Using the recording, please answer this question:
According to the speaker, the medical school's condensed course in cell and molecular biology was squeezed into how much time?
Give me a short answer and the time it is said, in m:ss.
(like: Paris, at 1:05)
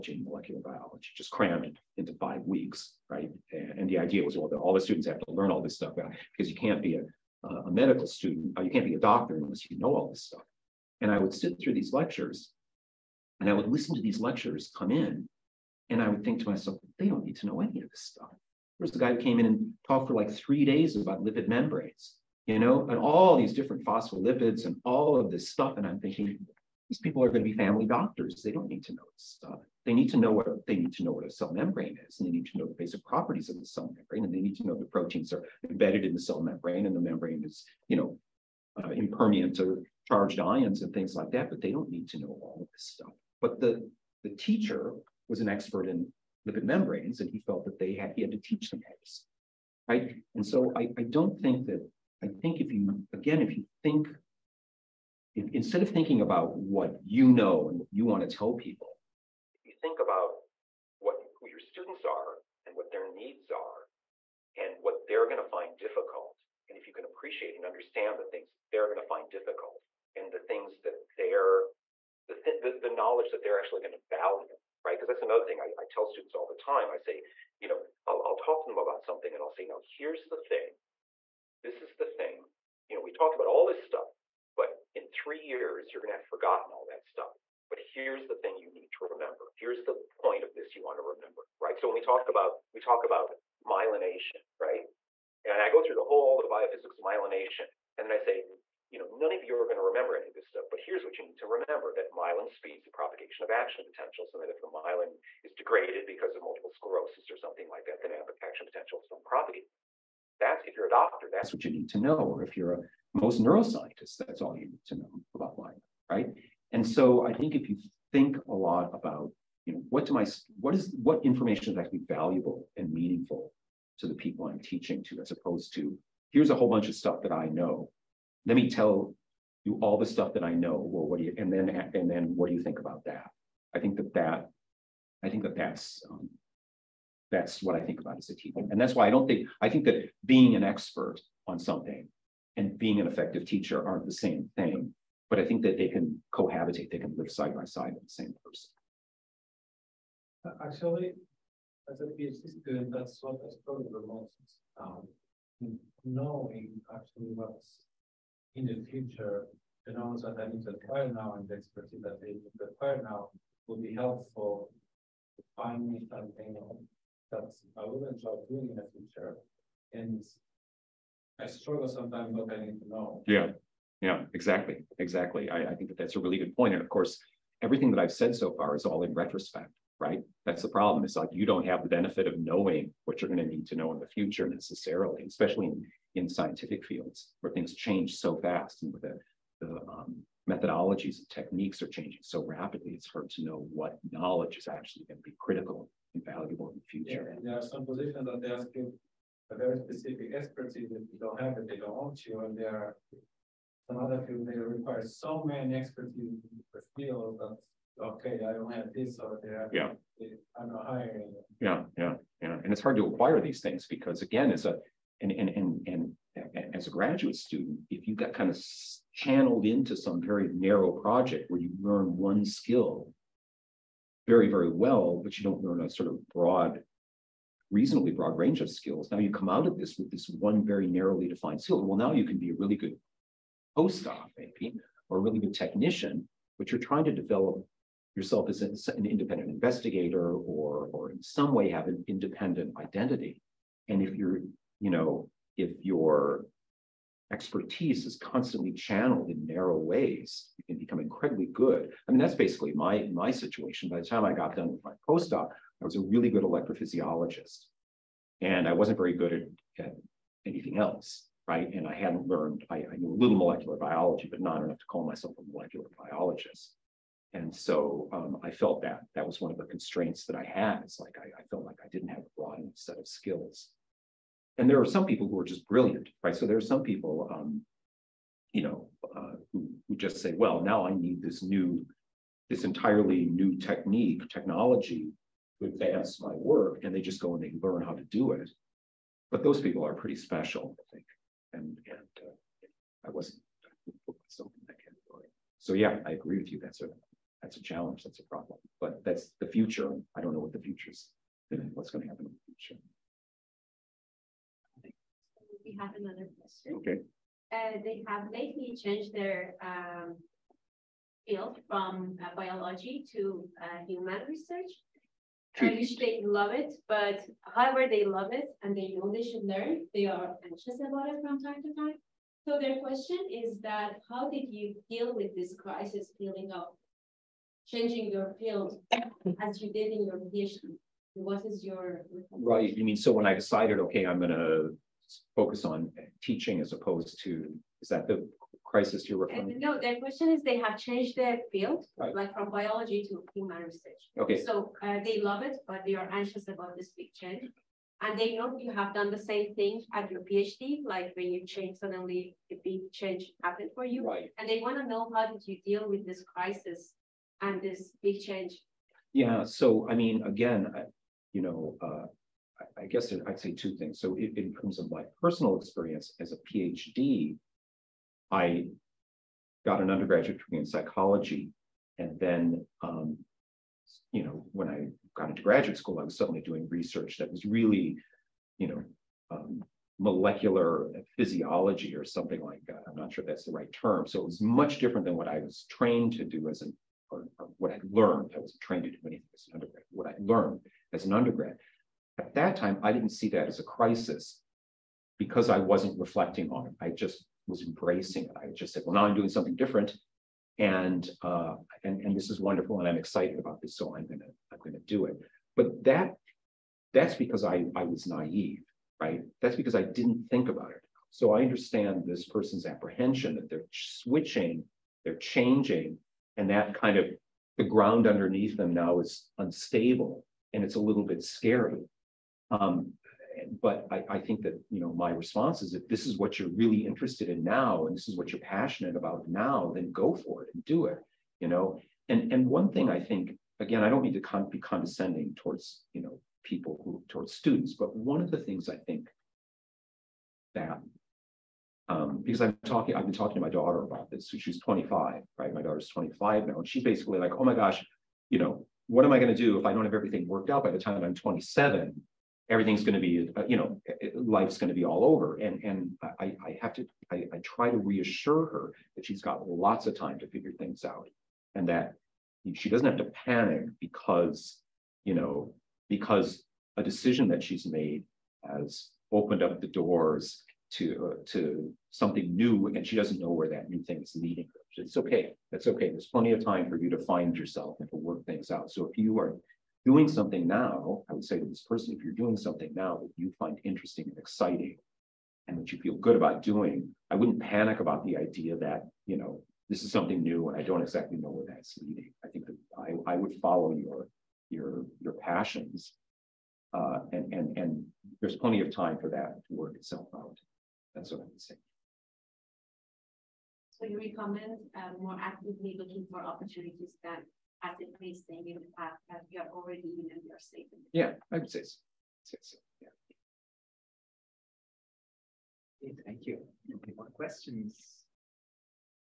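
5 weeks, at 0:02.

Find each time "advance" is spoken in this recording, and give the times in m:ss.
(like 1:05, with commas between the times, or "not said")
4:45.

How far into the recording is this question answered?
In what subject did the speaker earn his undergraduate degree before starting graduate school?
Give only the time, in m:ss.
6:10.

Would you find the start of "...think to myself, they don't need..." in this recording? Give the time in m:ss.
0:16.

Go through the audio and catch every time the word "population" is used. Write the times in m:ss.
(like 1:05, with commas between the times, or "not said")
not said.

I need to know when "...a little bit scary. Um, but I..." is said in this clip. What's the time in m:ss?
7:00.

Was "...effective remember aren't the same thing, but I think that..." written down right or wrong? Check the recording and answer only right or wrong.
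wrong.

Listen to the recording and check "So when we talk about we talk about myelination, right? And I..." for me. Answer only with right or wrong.
right.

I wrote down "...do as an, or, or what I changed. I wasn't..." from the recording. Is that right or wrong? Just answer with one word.
wrong.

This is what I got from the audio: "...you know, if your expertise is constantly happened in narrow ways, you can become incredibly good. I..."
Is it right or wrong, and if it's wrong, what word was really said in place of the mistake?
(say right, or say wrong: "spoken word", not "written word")
wrong: "channeled", not "happened".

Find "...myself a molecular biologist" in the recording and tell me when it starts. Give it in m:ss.
4:25.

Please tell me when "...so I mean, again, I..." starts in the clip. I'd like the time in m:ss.
5:59.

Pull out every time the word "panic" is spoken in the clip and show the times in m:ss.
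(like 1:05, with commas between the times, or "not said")
7:43, 8:07.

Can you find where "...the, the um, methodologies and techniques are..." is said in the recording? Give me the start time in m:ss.
3:09.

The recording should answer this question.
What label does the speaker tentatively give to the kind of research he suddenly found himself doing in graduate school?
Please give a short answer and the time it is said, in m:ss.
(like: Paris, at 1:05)
Molecular physiology, at 6:19.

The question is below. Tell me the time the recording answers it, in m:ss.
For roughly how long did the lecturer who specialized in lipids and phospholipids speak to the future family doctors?
0:20.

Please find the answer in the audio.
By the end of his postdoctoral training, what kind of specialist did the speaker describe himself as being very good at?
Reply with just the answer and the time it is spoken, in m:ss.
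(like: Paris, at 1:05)
Electrophysiologist, at 4:16.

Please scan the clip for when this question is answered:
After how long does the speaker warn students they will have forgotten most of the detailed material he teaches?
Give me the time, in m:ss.
1:25.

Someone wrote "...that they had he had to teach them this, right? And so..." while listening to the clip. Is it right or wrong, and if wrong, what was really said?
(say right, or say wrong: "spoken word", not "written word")
right.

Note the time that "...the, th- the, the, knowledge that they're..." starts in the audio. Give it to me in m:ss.
1:12.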